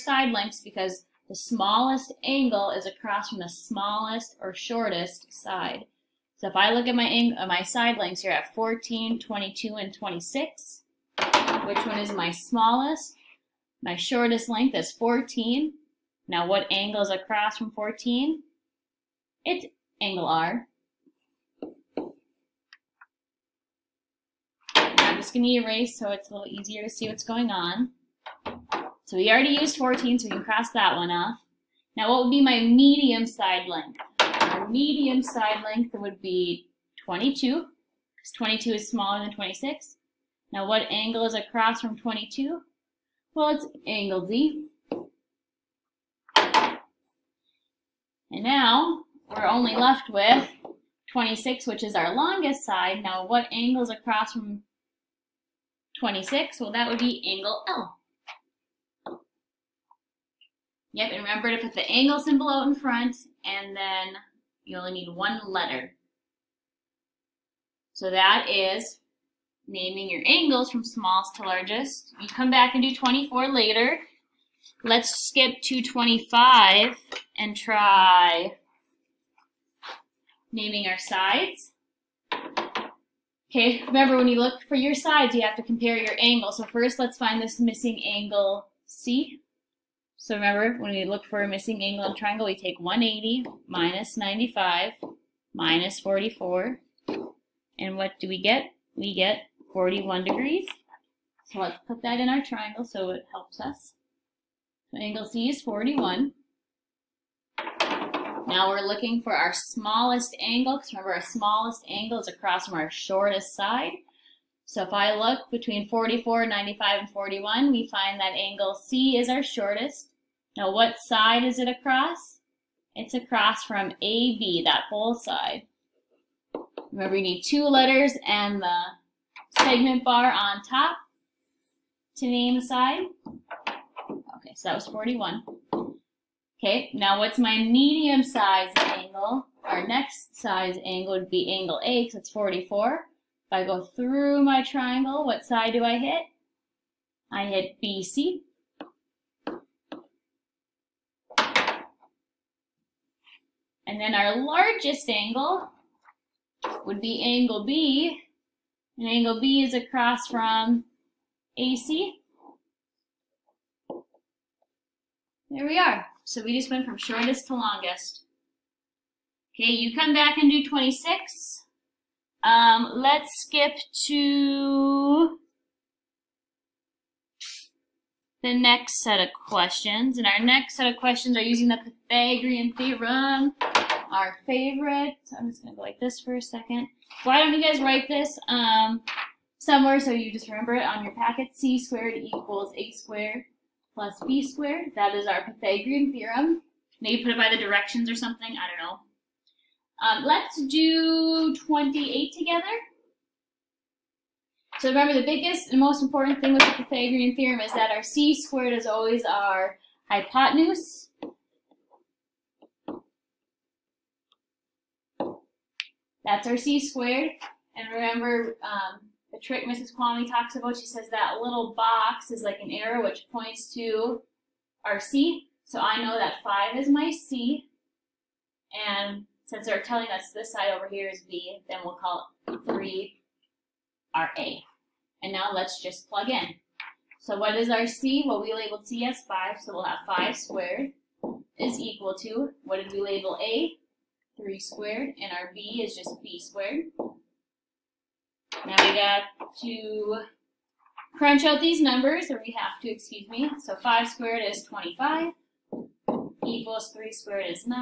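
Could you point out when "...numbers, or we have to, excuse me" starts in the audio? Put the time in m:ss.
4:11.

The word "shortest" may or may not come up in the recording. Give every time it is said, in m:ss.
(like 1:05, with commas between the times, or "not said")
0:04, 0:13, 1:52, 1:59, 2:46.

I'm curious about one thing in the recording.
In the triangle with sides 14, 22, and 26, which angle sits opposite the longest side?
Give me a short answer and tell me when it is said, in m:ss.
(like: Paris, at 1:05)
Angle L, at 0:57.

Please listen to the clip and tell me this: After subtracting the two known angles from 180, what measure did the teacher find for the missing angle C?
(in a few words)
41 degrees.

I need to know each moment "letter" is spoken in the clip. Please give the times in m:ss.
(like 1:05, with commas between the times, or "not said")
1:05, 2:07.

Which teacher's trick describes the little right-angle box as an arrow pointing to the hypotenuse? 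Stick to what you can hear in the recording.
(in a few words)
Mrs. Kwame.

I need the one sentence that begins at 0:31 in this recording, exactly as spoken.
Now what would be my medium side length?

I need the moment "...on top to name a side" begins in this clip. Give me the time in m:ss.
2:10.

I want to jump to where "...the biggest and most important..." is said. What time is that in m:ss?
3:25.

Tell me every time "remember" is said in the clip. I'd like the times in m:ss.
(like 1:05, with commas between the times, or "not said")
1:01, 1:23, 1:30, 1:50, 2:06, 3:10, 3:24, 3:37.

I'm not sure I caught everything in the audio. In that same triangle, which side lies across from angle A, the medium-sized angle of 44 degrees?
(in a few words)
BC.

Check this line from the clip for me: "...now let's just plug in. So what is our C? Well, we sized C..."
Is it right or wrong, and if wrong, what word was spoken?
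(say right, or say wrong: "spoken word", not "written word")
wrong: "labeled", not "sized".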